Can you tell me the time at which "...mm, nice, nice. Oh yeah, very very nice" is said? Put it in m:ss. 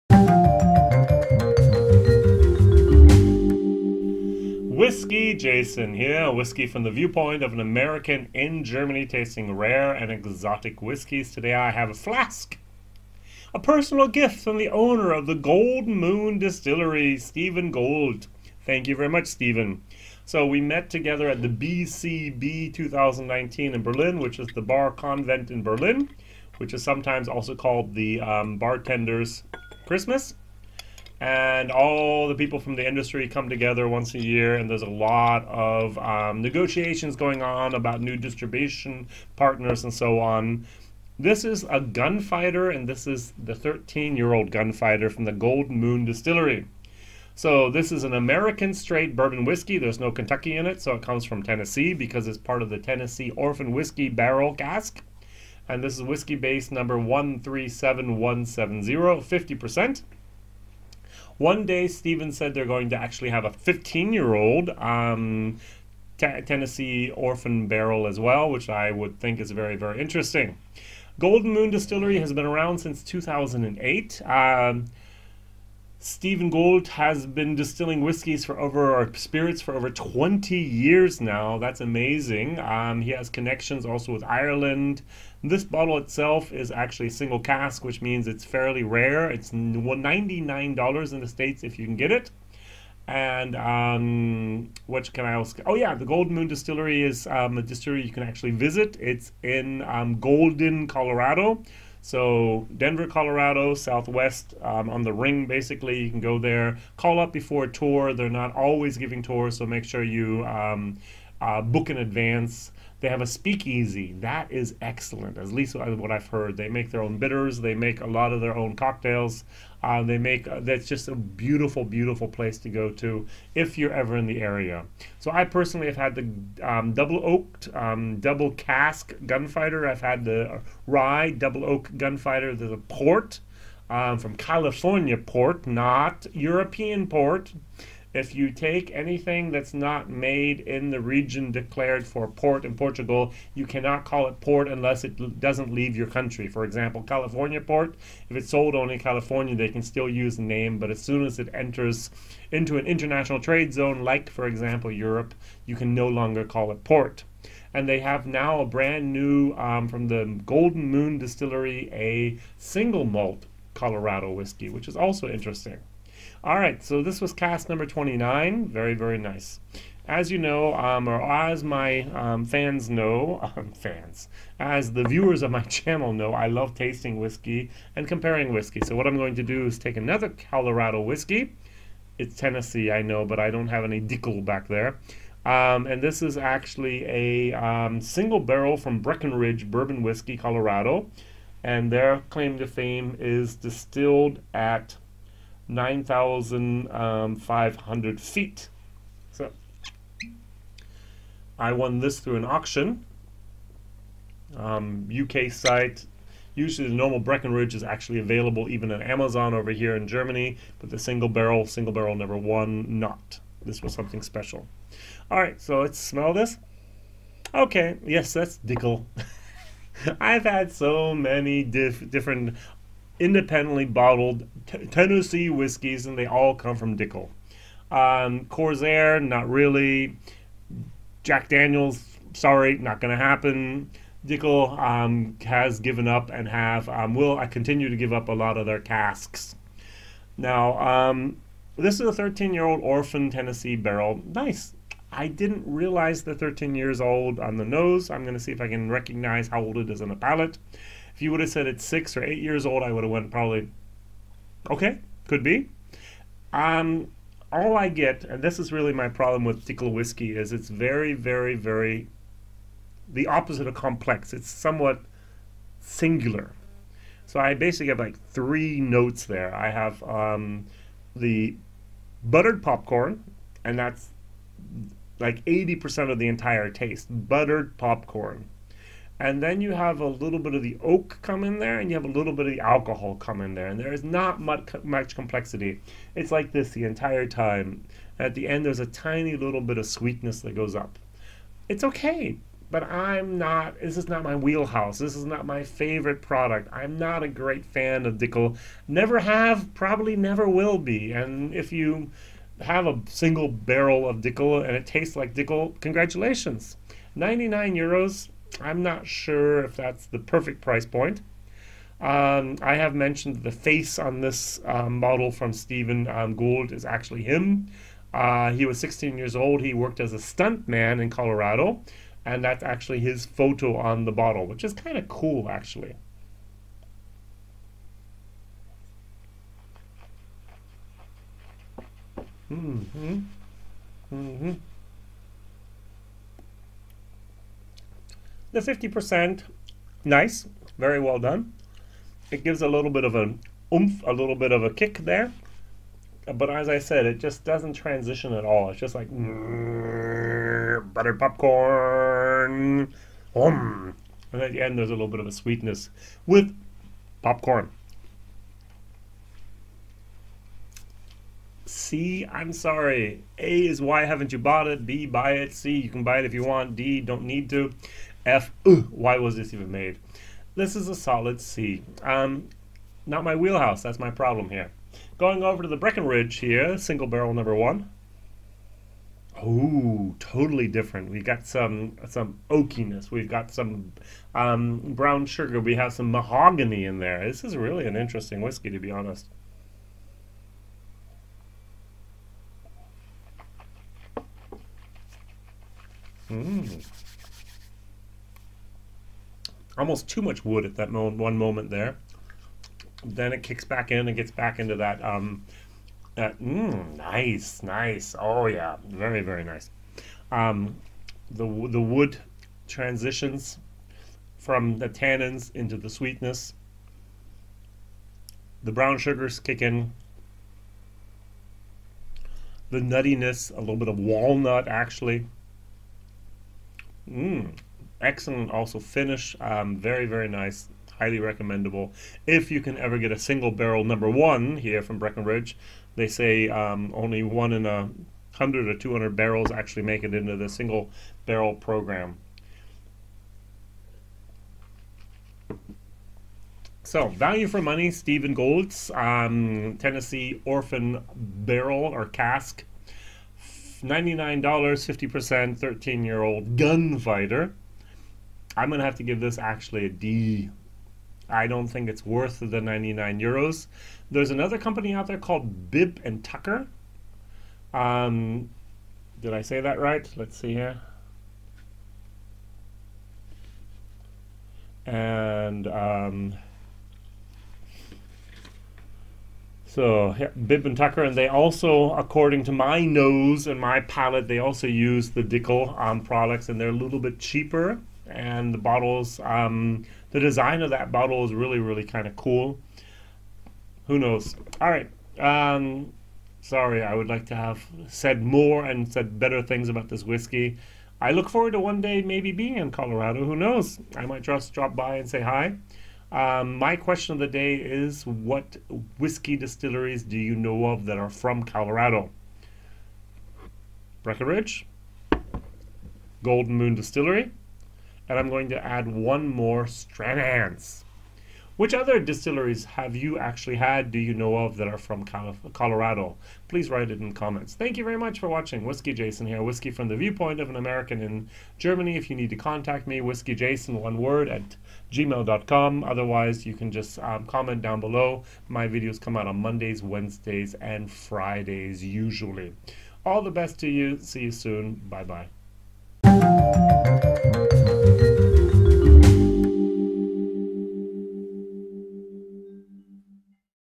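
6:46.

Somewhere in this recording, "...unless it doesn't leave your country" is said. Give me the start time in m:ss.
2:24.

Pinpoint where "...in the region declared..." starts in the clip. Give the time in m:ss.
2:20.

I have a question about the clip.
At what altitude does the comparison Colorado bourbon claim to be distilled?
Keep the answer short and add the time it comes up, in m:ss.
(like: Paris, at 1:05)
9,500 feet, at 3:15.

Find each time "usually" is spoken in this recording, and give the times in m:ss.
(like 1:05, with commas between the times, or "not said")
3:26, 9:01.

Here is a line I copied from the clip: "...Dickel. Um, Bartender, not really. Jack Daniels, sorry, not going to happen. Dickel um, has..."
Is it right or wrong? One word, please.
wrong.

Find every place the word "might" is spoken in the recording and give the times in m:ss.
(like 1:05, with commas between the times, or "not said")
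8:24.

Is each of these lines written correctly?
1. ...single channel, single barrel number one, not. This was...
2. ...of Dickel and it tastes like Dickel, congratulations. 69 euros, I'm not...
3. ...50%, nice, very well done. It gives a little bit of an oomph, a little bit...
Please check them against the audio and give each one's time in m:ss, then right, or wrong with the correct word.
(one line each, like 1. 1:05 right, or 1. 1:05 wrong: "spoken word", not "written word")
1. 3:30 wrong: "barrel", not "channel"
2. 5:04 wrong: "99", not "69"
3. 5:38 right.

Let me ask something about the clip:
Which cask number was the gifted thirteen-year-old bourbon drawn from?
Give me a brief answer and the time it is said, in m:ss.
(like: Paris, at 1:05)
29, at 2:47.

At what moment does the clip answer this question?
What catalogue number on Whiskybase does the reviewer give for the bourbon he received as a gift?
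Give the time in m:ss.
0:56.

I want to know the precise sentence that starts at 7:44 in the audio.
There's another company out there called Bib and Tucker.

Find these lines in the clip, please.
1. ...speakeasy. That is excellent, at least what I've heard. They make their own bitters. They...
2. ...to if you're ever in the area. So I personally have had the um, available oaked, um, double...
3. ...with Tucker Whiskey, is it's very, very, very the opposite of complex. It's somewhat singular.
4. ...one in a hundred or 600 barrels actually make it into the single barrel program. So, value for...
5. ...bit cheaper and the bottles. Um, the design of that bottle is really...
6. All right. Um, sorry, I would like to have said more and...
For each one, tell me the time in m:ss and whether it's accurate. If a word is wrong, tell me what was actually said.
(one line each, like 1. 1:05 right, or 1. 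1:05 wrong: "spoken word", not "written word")
1. 1:53 right
2. 2:02 wrong: "double", not "available"
3. 4:19 wrong: "Dickel", not "Tucker"
4. 7:17 wrong: "200", not "600"
5. 8:06 right
6. 8:14 right.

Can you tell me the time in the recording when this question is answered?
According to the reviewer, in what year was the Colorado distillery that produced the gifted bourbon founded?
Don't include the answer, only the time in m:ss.
1:13.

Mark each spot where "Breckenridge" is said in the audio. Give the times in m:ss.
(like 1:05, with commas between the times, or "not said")
3:08, 3:27, 6:15, 7:14, 8:34.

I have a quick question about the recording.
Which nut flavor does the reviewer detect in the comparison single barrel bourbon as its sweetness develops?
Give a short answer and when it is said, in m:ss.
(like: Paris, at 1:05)
walnut, at 7:03.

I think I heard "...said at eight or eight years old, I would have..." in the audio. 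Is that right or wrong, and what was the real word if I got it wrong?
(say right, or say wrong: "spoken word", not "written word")
wrong: "six", not "eight".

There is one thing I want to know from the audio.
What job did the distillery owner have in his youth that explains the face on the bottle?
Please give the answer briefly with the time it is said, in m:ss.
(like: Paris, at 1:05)
stunt man, at 5:20.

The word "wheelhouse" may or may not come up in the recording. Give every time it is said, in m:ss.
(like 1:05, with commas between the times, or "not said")
4:54, 6:13.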